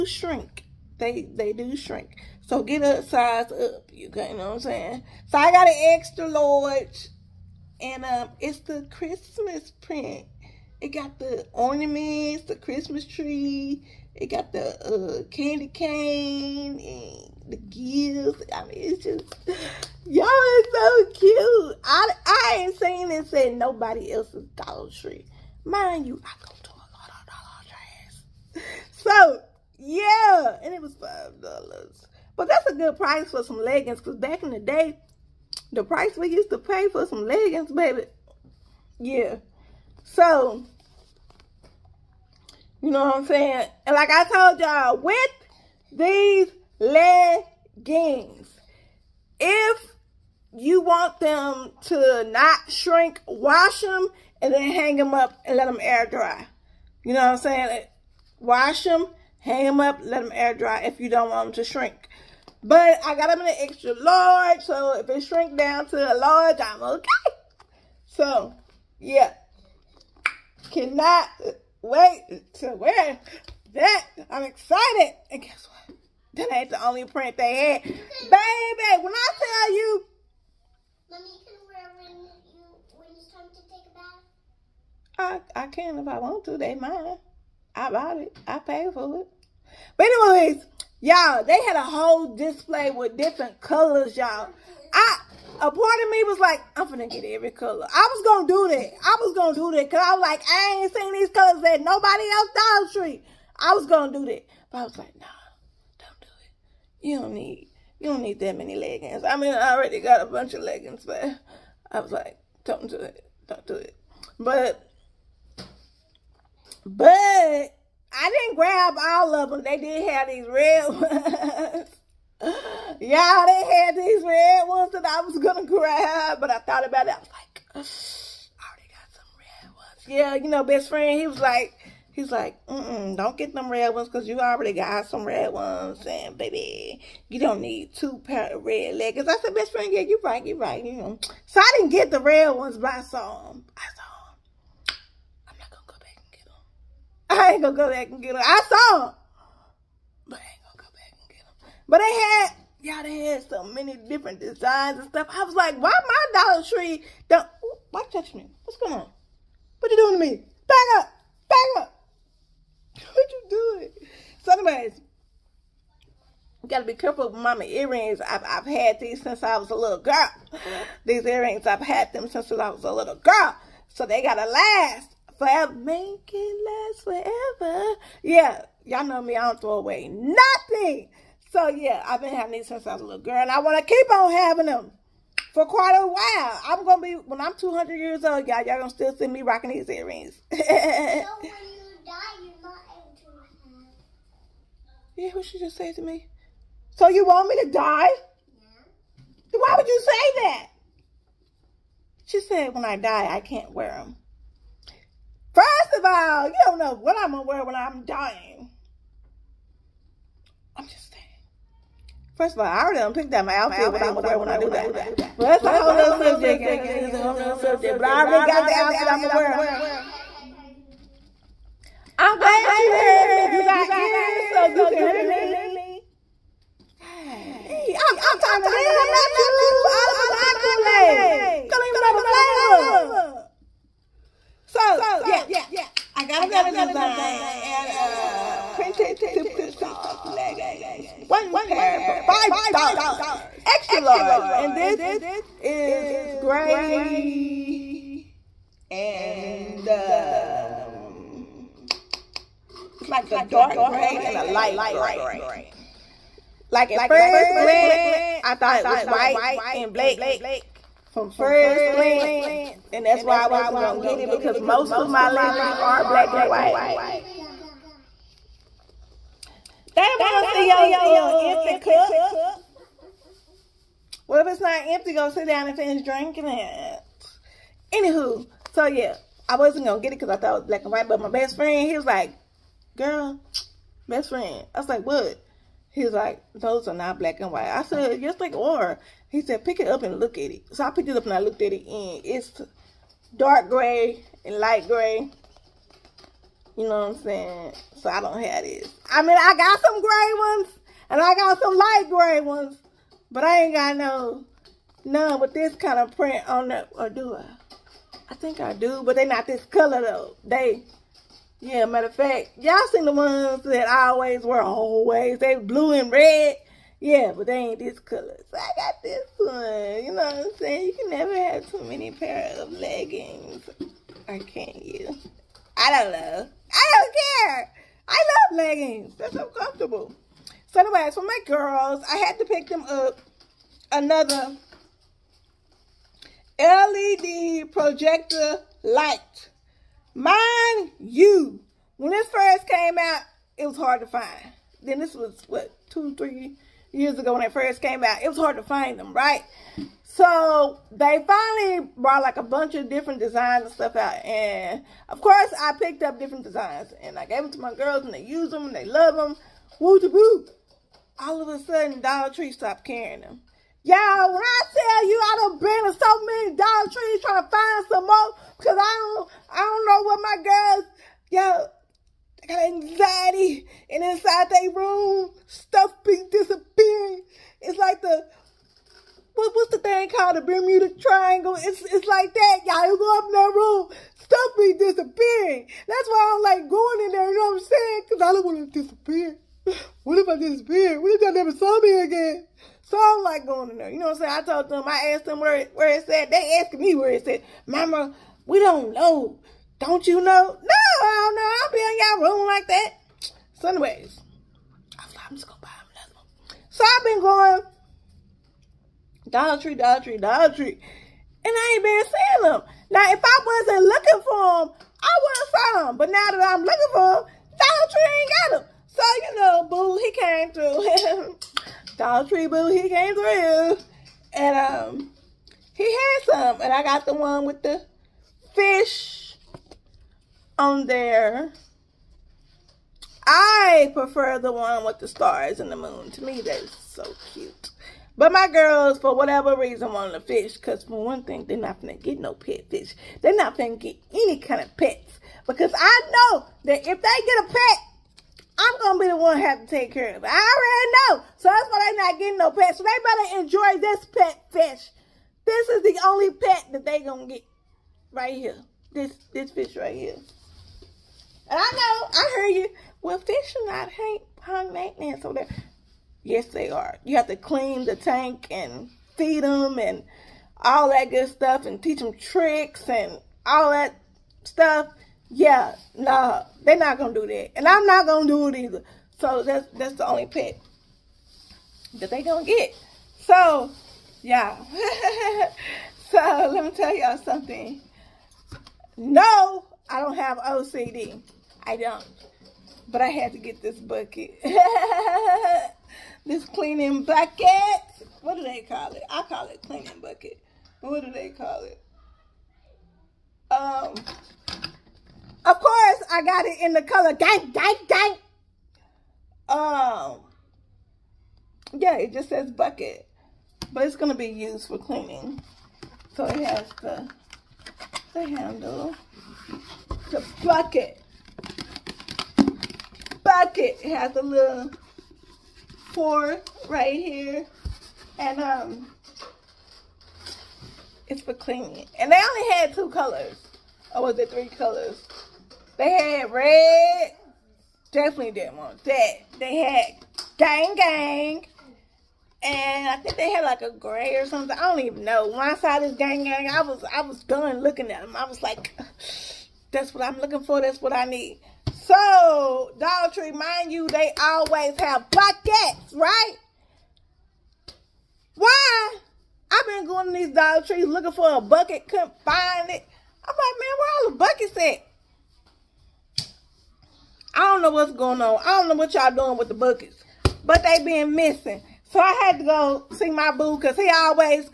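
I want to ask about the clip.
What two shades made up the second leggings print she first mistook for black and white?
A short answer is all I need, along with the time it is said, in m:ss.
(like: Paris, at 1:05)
Dark gray and light gray, at 4:13.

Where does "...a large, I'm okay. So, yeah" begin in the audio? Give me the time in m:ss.
1:05.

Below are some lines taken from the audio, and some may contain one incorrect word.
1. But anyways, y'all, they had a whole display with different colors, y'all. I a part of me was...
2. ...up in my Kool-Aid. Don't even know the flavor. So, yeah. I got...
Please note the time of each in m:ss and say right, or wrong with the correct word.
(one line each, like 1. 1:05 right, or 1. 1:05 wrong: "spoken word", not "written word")
1. 1:29 right
2. 3:50 right.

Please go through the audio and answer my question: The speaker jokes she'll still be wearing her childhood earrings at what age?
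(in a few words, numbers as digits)
200.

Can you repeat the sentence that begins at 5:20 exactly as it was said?
You can never have too many pair of leggings.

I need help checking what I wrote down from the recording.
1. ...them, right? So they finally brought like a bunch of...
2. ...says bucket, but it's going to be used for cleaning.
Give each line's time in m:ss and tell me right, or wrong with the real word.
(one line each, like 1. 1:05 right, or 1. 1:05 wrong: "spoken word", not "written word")
1. 5:48 right
2. 8:32 right.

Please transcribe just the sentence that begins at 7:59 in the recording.
So that's that's the only pet that they gonna get.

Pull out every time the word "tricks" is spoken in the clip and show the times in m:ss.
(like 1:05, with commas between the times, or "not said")
7:52.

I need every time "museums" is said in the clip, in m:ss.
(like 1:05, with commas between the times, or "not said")
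not said.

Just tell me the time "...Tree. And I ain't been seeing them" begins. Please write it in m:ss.
6:50.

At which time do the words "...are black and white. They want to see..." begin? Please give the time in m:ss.
4:25.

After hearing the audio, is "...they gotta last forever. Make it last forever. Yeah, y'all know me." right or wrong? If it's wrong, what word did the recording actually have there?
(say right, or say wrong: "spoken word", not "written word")
right.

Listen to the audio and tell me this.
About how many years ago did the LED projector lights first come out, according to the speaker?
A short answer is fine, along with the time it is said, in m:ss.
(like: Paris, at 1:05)
Two, three years, at 5:45.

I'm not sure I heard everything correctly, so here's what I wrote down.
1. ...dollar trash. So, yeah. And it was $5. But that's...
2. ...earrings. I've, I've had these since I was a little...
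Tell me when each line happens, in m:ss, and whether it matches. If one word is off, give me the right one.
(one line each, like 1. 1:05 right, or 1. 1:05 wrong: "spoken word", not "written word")
1. 0:28 right
2. 2:47 right.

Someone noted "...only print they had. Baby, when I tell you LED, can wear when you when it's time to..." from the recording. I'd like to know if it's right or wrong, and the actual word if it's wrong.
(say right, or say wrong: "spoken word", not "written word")
wrong: "Mommy", not "LED".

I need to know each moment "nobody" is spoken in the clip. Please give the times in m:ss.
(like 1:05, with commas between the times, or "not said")
0:23, 1:41.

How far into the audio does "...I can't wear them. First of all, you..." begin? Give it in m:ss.
3:23.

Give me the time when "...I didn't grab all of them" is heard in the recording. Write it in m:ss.
1:57.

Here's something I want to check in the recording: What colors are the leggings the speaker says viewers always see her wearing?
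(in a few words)
Blue and red.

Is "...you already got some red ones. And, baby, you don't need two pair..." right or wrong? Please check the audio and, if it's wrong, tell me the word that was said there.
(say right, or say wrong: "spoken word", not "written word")
right.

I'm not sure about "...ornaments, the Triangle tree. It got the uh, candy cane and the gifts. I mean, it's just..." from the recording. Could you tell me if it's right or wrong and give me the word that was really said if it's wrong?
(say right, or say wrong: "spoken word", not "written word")
wrong: "Christmas", not "Triangle".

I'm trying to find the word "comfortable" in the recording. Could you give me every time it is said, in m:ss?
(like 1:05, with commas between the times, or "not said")
5:29.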